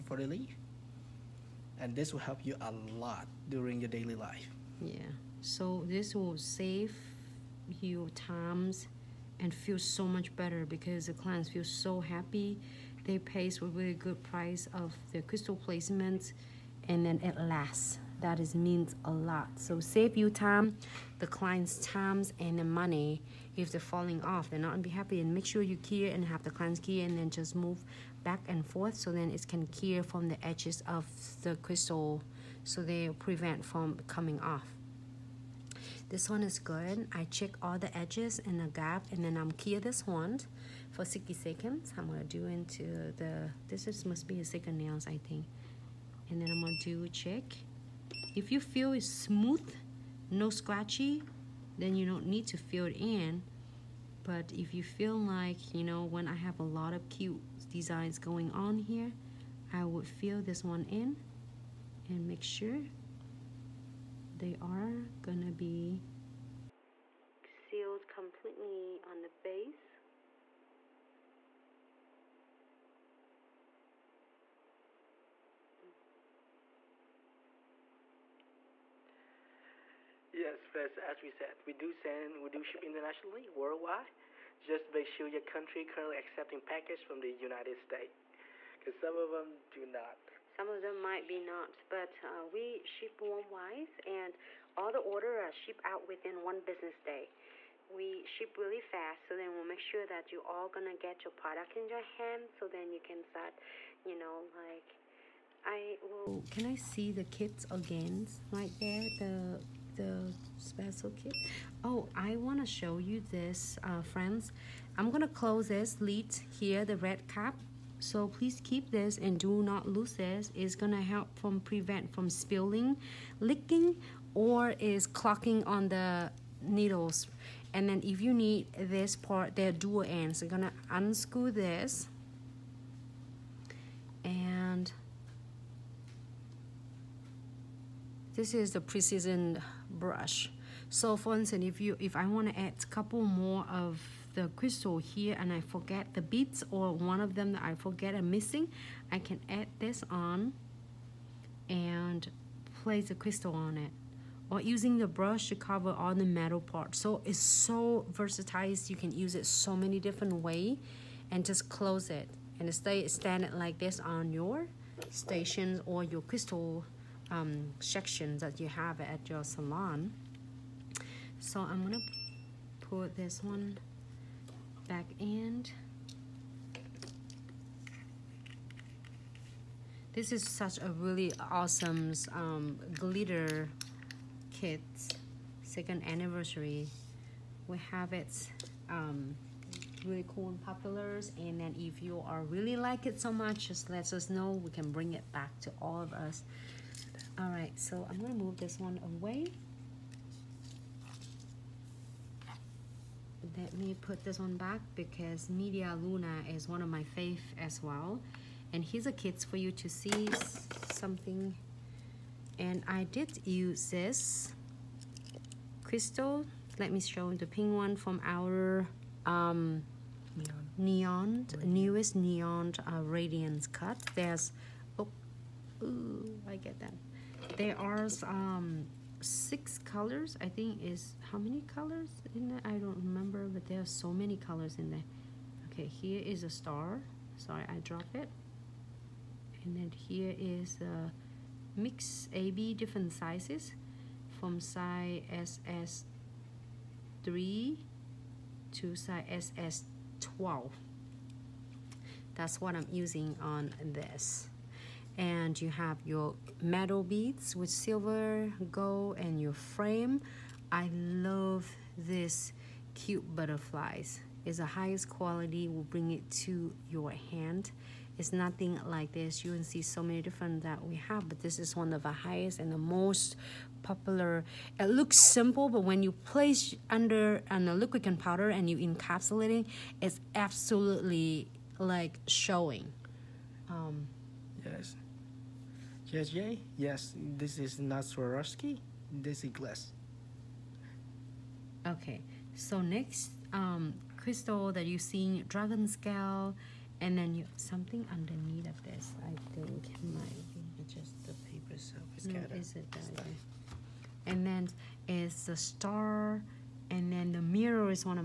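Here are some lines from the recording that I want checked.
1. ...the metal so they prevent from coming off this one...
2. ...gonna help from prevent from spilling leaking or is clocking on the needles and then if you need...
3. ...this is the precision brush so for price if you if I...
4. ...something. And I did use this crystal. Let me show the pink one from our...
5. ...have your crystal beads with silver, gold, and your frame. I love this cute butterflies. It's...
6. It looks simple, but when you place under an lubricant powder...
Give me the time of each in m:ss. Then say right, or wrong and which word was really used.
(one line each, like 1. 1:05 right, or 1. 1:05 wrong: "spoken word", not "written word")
1. 0:31 wrong: "crystal", not "metal"
2. 2:00 right
3. 2:18 wrong: "instance", not "price"
4. 3:30 right
5. 4:15 wrong: "metal", not "crystal"
6. 4:34 right.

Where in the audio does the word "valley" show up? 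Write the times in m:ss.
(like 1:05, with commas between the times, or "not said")
not said.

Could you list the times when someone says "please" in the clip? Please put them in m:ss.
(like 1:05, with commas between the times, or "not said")
1:58.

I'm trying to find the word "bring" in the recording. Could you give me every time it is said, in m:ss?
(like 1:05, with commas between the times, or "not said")
3:14, 4:25.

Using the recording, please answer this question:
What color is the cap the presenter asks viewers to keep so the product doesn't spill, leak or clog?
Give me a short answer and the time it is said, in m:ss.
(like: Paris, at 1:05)
red, at 1:56.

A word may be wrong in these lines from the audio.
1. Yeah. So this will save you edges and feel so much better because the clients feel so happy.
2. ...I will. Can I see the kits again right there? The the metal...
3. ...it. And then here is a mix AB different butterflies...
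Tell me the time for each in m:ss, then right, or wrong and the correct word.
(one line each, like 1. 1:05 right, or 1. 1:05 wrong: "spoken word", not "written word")
1. 0:04 wrong: "times", not "edges"
2. 1:45 wrong: "special", not "metal"
3. 3:58 wrong: "sizes", not "butterflies".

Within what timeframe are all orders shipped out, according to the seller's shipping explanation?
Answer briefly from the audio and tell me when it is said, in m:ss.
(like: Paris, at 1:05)
one business day, at 1:36.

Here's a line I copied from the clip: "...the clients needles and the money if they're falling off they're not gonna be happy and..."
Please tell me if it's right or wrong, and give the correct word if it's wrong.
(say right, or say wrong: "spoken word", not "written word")
wrong: "times", not "needles".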